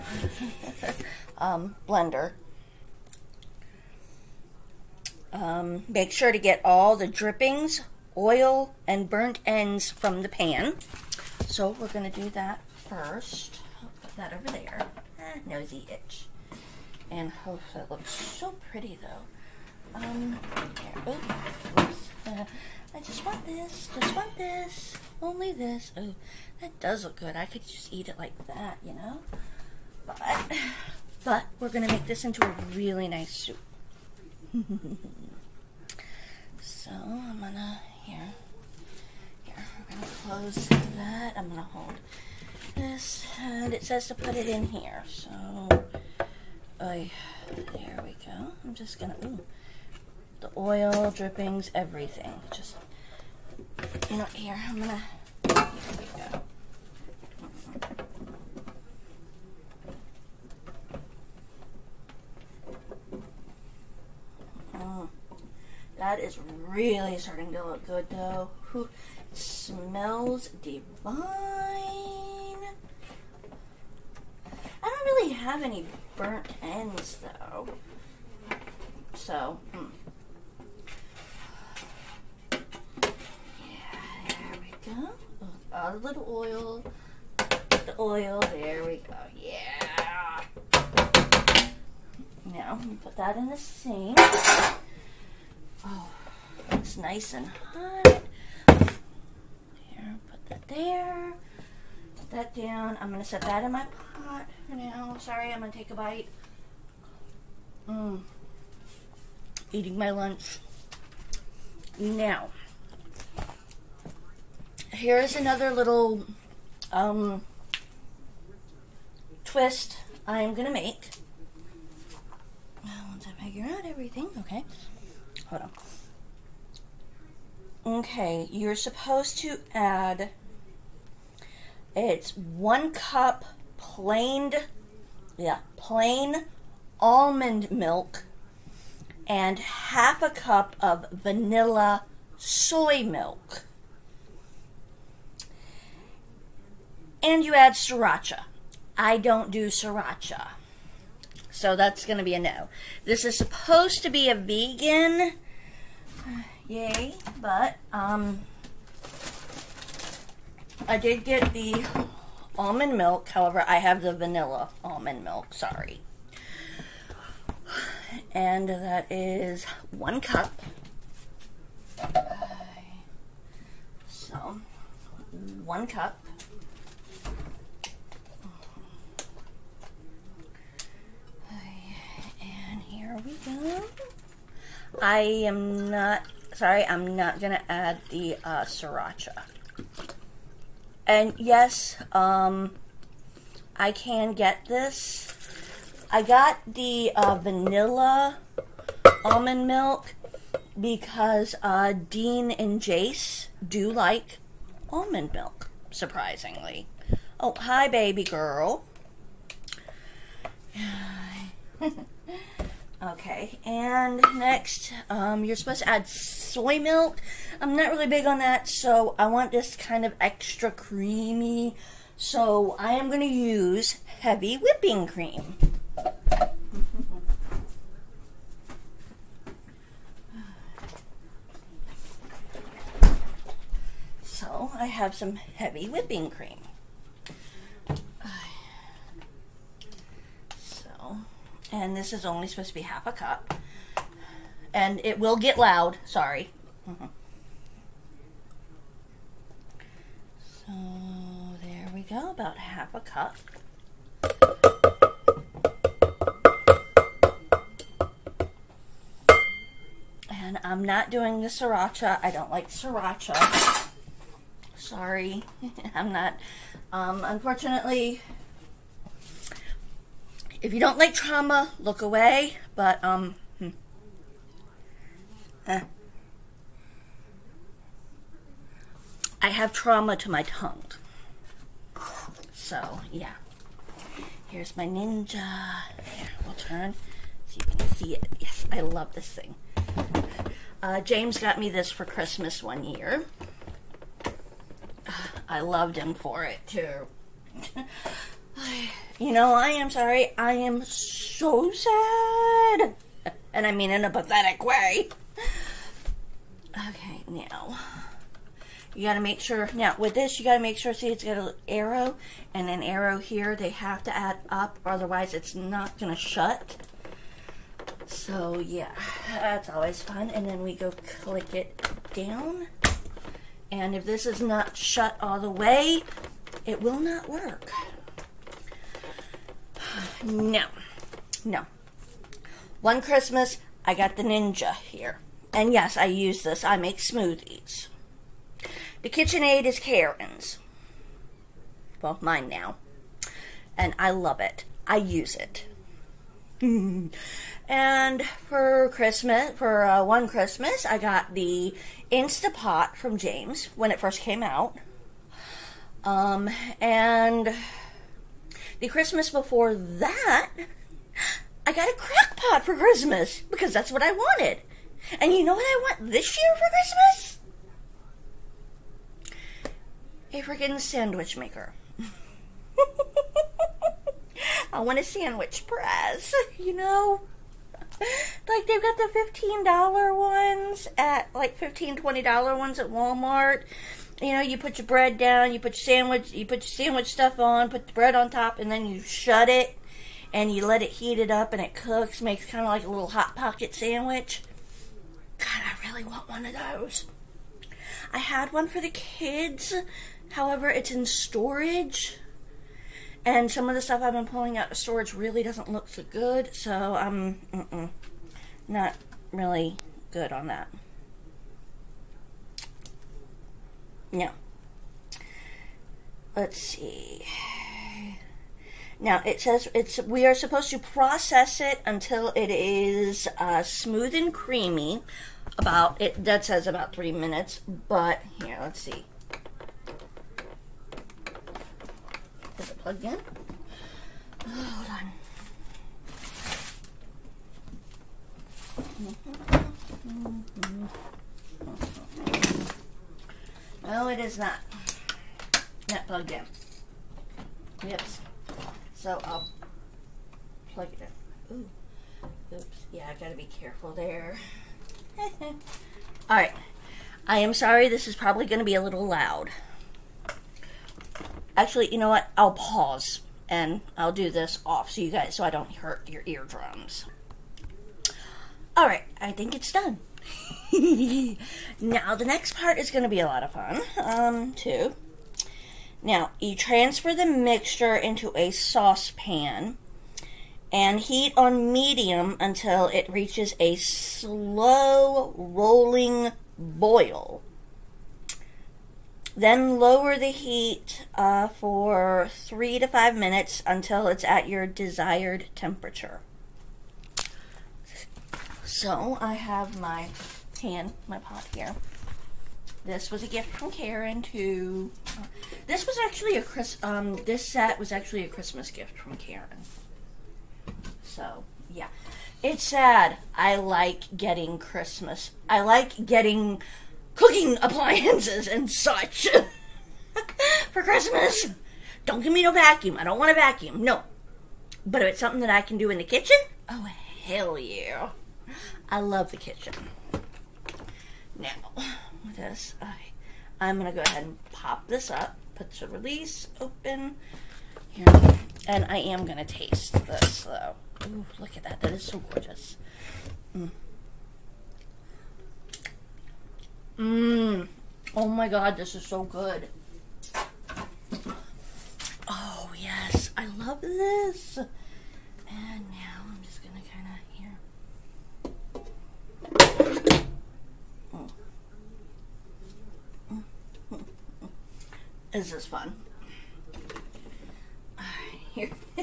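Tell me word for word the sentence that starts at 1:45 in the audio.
Sorry, I'm gonna take a bite.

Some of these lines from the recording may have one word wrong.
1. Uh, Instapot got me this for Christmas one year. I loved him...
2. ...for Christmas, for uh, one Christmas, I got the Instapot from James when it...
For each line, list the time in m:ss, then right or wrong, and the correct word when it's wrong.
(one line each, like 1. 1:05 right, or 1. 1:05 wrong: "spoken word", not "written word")
1. 4:50 wrong: "James", not "Instapot"
2. 5:48 right.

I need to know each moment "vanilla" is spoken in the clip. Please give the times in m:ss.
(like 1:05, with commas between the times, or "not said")
2:21, 2:44, 3:17.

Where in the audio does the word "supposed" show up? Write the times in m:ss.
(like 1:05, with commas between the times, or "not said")
2:08, 2:33, 3:35, 4:02, 7:00.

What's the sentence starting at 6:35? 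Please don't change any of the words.
God, I really want one of those.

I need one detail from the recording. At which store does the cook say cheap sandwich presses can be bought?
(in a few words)
Walmart.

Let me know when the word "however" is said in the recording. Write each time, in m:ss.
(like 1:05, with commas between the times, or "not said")
2:43, 6:40.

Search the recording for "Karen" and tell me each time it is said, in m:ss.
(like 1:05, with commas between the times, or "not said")
5:39, 8:23, 8:29.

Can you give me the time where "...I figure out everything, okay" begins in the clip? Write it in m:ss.
2:03.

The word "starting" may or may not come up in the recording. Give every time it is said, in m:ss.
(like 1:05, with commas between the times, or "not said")
1:07.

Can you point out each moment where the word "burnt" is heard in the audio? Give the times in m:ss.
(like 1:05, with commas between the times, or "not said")
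0:09, 1:16.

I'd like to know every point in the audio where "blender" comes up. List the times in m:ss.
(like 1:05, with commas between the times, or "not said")
0:01.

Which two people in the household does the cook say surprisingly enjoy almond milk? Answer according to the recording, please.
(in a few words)
Dean and Jace.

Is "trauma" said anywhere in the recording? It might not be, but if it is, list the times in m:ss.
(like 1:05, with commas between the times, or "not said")
4:31, 4:39.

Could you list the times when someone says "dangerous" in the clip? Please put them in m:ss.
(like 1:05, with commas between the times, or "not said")
not said.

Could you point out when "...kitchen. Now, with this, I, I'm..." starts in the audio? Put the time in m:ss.
8:49.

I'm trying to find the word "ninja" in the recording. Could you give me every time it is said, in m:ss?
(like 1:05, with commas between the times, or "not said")
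4:44, 5:34.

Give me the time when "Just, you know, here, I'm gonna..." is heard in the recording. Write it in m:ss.
0:52.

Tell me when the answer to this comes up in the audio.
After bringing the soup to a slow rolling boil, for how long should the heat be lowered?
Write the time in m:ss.
8:12.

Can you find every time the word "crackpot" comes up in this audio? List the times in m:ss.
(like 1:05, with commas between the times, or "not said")
6:01.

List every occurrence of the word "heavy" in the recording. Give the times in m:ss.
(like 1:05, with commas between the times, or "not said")
3:44, 3:55.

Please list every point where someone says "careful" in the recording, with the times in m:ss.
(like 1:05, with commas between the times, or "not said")
7:33.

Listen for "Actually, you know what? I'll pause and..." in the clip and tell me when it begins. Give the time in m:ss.
7:41.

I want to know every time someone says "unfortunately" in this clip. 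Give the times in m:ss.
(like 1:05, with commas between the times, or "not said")
4:27.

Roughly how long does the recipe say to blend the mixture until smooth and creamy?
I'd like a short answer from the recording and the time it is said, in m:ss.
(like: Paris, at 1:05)
3 minutes, at 7:06.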